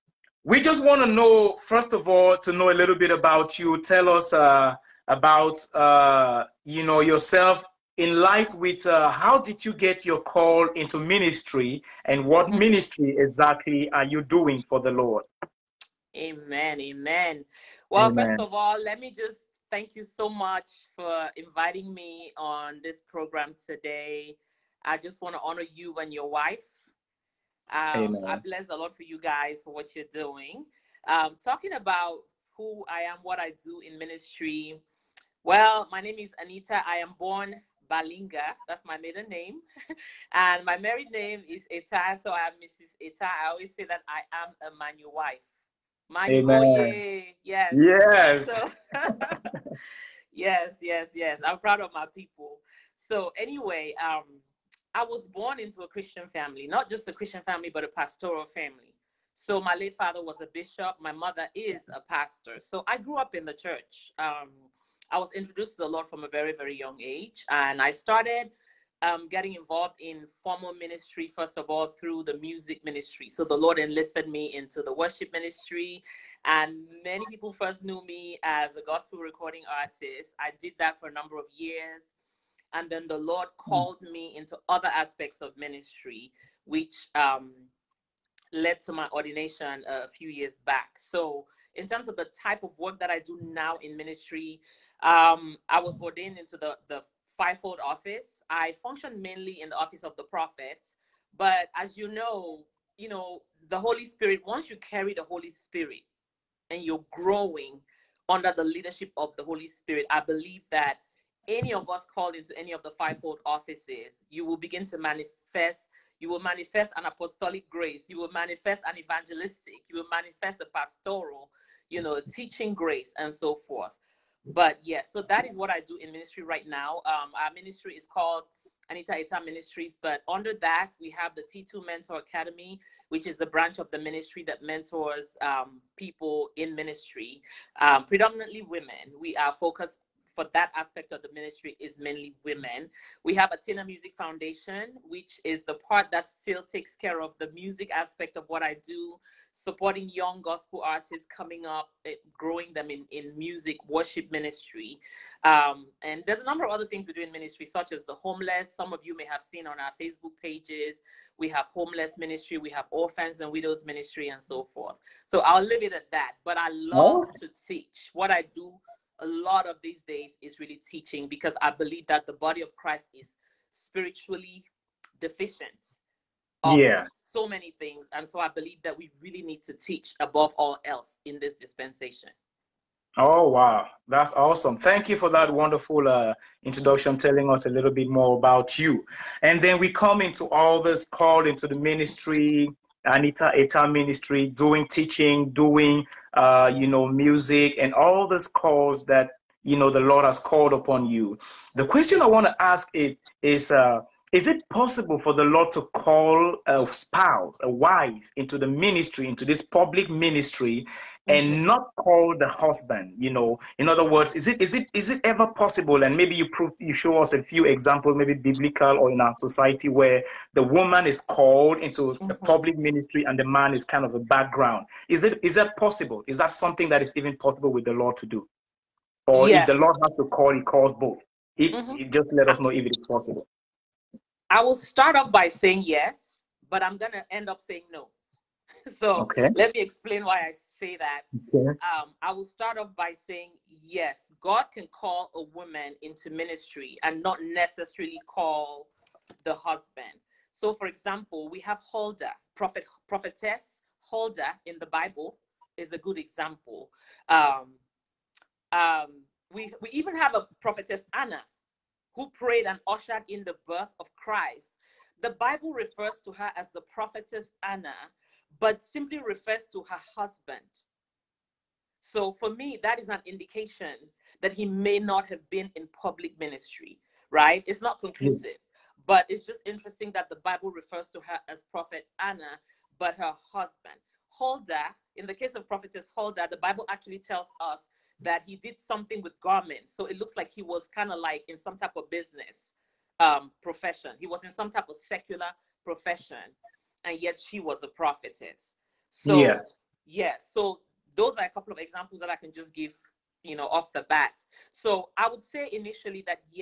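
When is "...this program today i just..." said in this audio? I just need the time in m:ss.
0:22.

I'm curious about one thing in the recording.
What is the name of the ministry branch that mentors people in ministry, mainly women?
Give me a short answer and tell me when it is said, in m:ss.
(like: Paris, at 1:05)
T2 Mentor Academy, at 2:11.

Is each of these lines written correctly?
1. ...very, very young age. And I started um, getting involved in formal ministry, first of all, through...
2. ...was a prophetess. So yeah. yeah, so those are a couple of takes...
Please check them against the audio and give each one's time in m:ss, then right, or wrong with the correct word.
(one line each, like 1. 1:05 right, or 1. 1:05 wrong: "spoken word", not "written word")
1. 1:06 right
2. 4:57 wrong: "examples", not "takes".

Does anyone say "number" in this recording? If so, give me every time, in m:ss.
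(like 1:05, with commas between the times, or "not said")
1:21, 2:36.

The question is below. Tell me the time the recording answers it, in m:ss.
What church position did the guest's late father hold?
1:00.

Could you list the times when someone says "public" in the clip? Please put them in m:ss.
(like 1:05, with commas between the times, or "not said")
3:29, 3:42, 4:35.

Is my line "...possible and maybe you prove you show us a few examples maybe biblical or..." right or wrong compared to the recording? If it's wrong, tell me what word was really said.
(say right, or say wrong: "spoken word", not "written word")
right.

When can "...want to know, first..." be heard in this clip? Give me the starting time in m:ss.
0:00.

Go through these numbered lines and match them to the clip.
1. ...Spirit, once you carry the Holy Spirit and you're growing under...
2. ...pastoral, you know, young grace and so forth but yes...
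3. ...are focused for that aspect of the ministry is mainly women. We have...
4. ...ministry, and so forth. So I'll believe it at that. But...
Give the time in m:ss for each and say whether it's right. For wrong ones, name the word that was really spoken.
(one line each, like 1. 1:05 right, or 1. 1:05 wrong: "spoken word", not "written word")
1. 1:44 right
2. 2:00 wrong: "teaching", not "young"
3. 2:19 right
4. 2:43 wrong: "leave", not "believe".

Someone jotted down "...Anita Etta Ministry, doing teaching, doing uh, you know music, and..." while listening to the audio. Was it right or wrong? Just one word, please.
right.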